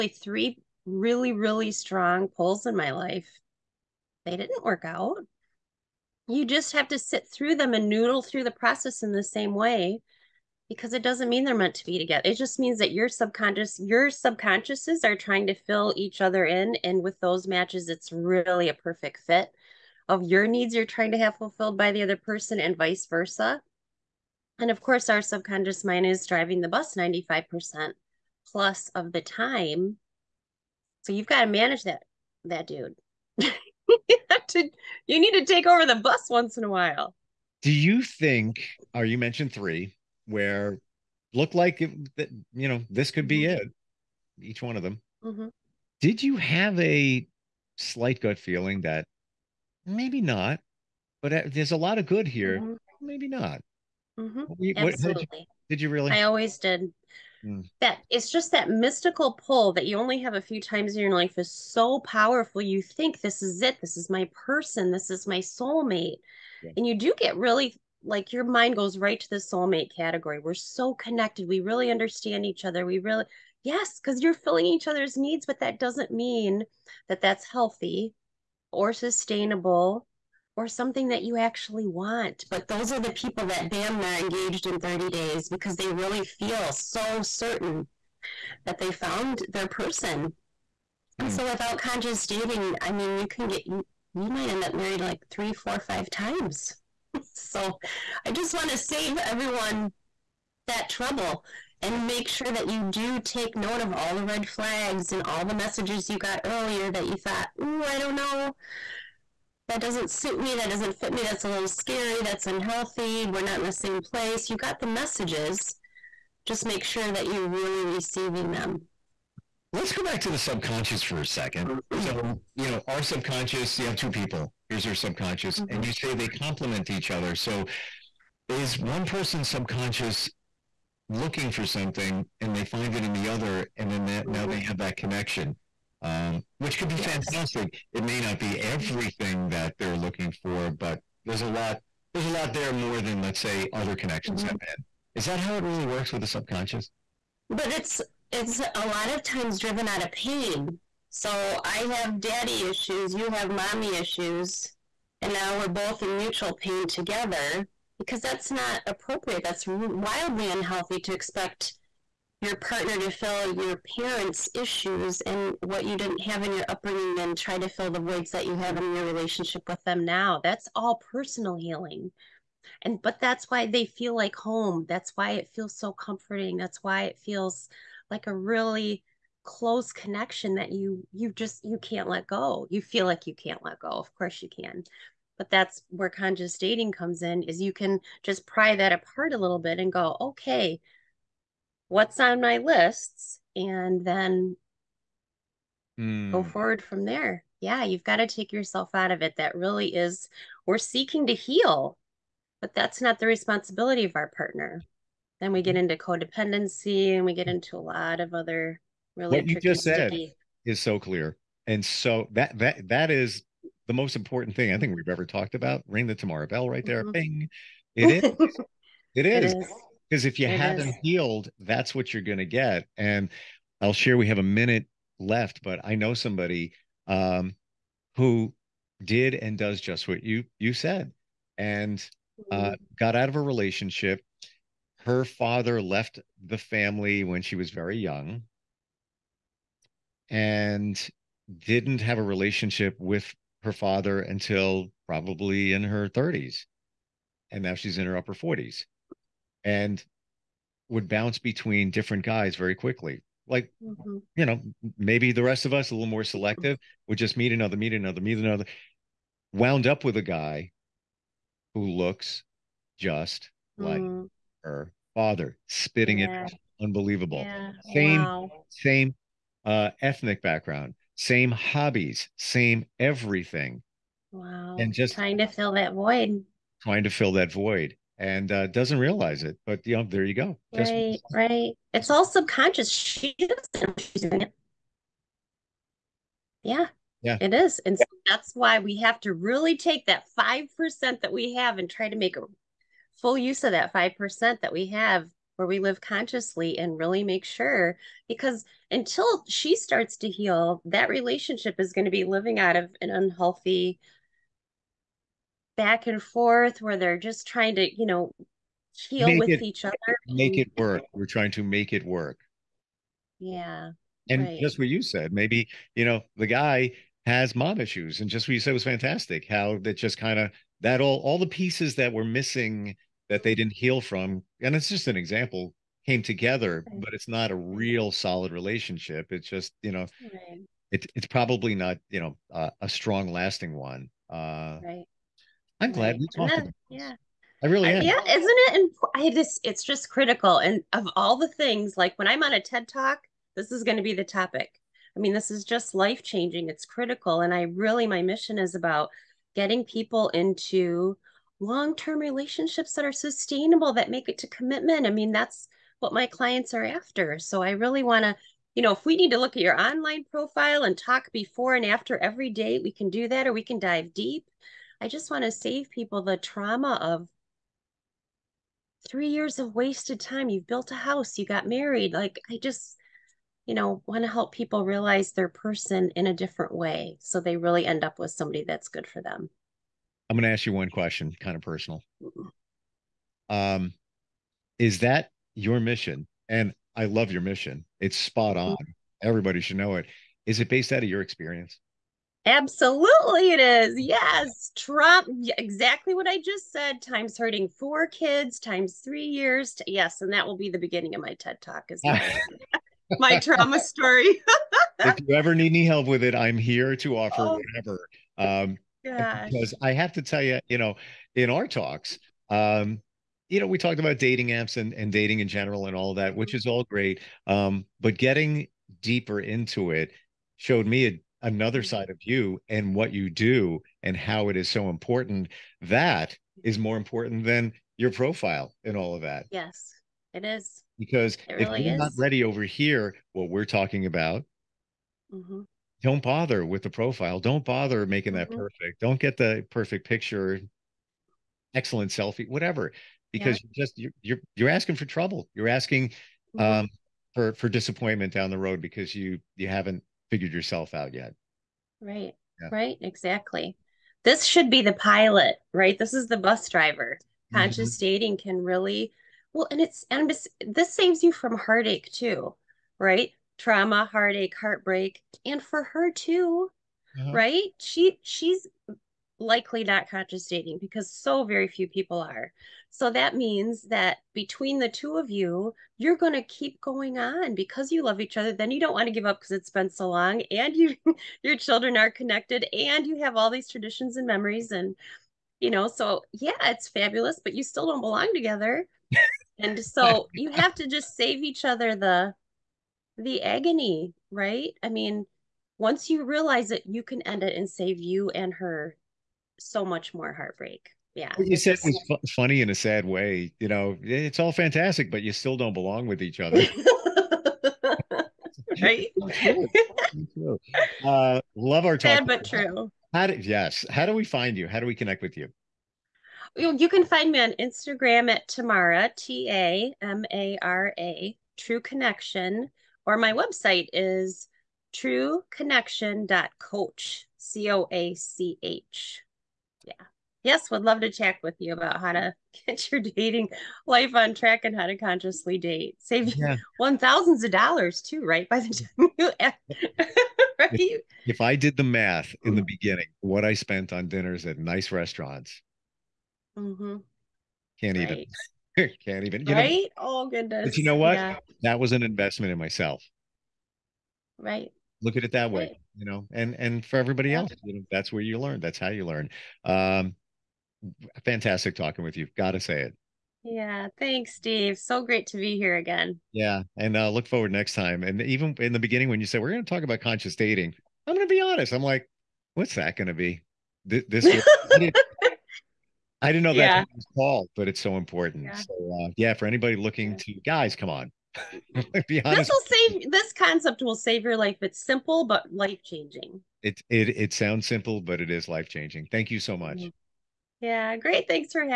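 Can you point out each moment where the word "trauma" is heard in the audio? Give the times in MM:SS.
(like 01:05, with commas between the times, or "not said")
06:06, 06:43, 07:43.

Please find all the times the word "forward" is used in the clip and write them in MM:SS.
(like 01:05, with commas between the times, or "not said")
03:16, 09:27.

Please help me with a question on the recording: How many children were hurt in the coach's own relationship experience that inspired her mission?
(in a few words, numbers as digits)
4.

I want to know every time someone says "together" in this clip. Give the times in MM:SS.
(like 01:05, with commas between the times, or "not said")
00:11, 02:36, 05:26, 08:08.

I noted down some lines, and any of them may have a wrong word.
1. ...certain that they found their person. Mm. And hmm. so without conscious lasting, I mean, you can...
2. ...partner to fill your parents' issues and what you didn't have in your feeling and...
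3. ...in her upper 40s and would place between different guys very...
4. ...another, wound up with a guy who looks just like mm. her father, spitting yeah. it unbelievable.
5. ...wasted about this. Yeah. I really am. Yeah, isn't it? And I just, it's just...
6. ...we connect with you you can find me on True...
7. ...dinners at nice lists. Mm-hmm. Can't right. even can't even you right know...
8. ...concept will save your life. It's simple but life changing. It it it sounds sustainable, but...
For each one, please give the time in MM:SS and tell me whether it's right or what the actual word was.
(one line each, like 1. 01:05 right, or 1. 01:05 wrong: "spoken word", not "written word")
1. 01:27 wrong: "dating", not "lasting"
2. 02:42 wrong: "upbringing", not "feeling"
3. 04:07 wrong: "bounce", not "place"
4. 04:18 right
5. 05:36 wrong: "talked", not "wasted"
6. 08:34 wrong: "Instagram", not "True"
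7. 09:04 wrong: "restaurants", not "lists"
8. 09:43 wrong: "simple", not "sustainable".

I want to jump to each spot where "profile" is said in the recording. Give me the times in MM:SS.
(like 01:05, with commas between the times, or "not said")
06:00, 07:08, 07:16.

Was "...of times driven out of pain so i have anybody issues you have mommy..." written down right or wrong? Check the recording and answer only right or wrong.
wrong.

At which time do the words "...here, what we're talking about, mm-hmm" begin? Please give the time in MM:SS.
07:12.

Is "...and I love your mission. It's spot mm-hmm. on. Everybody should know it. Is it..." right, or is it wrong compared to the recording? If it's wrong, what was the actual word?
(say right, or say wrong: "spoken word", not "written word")
right.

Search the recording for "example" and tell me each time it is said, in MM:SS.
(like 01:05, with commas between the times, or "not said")
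05:25.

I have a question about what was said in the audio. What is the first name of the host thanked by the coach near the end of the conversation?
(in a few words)
Steve.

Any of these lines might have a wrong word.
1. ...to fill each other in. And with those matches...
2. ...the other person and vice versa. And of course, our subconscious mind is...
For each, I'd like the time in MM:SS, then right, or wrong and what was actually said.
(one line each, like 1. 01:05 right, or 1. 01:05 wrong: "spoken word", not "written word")
1. 00:15 right
2. 00:21 right.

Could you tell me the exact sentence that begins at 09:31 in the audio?
I'm like, what's that going to be?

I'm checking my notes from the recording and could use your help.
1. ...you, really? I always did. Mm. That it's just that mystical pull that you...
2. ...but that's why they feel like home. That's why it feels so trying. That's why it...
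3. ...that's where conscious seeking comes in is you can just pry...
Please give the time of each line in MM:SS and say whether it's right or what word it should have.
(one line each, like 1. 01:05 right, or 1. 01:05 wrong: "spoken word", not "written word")
1. 00:55 right
2. 02:53 wrong: "comforting", not "trying"
3. 03:05 wrong: "dating", not "seeking".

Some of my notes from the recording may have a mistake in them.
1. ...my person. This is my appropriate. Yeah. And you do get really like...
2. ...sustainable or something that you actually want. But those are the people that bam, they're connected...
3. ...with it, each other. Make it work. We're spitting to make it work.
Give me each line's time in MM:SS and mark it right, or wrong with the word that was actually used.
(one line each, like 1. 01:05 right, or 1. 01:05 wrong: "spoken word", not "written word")
1. 01:04 wrong: "soulmate", not "appropriate"
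2. 01:18 wrong: "engaged", not "connected"
3. 05:09 wrong: "trying", not "spitting".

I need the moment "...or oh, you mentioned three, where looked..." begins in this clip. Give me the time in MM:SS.
00:38.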